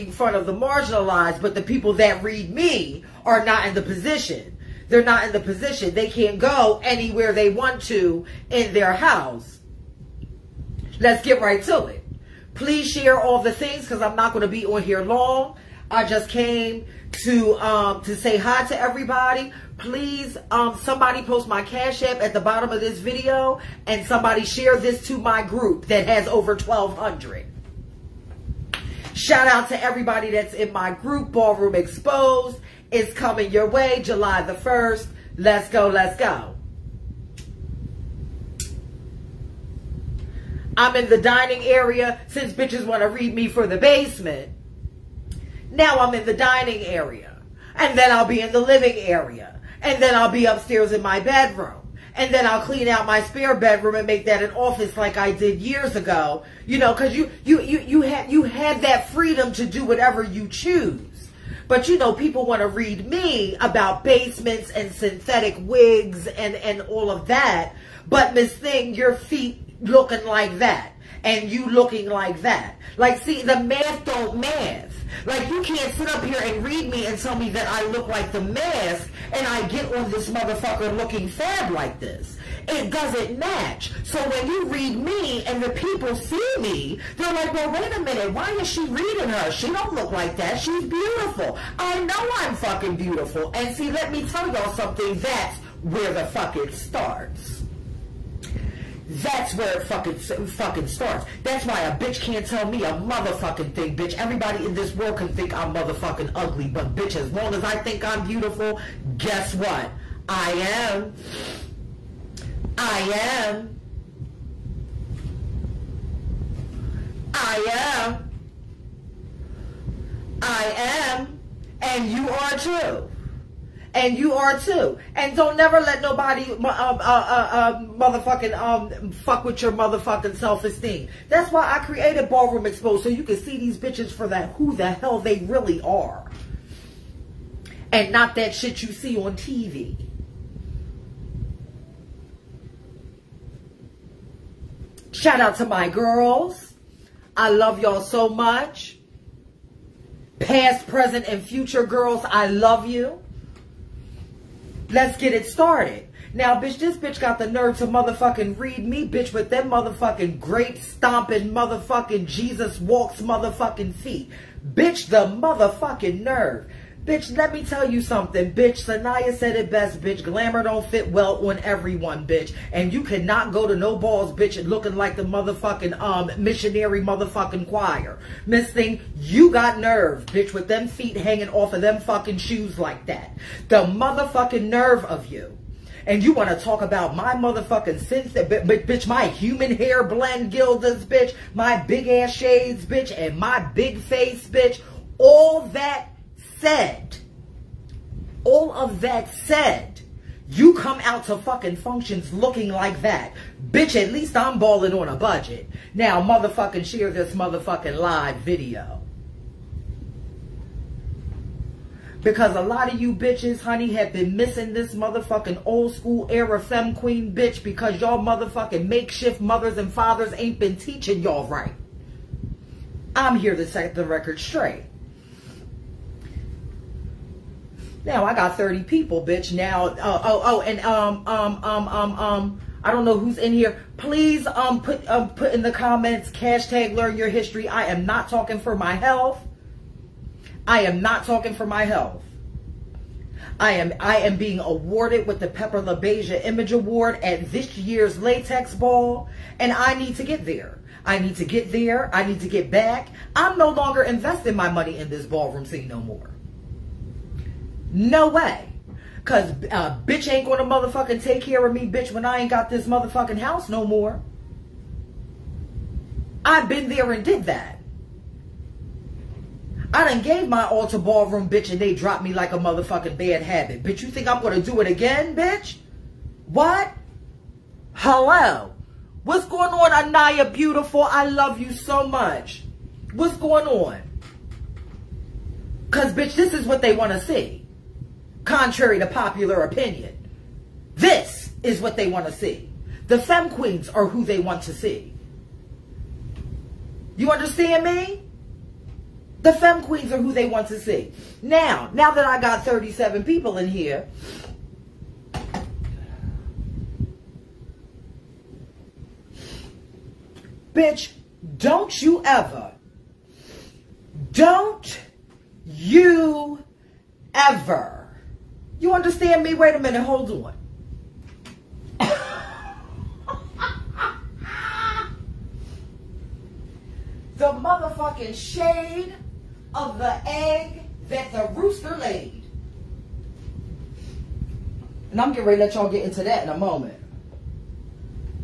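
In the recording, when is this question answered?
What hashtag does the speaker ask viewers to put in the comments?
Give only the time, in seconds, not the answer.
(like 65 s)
236 s.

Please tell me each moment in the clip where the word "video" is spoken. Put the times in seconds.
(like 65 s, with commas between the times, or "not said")
22 s, 208 s.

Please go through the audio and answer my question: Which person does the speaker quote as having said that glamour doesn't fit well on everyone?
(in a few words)
Sanaya.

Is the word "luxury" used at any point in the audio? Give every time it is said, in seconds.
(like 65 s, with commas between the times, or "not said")
not said.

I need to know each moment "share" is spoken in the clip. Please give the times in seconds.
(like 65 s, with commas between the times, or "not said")
12 s, 24 s, 206 s.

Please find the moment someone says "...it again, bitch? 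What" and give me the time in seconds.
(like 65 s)
274 s.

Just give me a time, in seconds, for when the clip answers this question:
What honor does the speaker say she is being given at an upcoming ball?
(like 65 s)
245 s.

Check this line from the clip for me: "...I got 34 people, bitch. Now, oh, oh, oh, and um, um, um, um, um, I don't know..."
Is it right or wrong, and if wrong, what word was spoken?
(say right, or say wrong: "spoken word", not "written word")
wrong: "30", not "34".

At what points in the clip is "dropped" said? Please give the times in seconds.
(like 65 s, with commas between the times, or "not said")
271 s.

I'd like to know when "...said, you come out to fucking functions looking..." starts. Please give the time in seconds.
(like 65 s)
199 s.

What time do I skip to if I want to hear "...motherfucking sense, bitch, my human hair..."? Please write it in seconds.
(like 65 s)
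187 s.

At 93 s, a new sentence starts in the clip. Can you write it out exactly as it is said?
And see, let me tell y'all something.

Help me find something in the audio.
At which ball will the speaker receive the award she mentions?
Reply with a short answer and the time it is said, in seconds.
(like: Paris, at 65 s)
Latex Ball, at 248 s.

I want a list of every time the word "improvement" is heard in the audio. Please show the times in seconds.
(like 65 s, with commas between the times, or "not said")
not said.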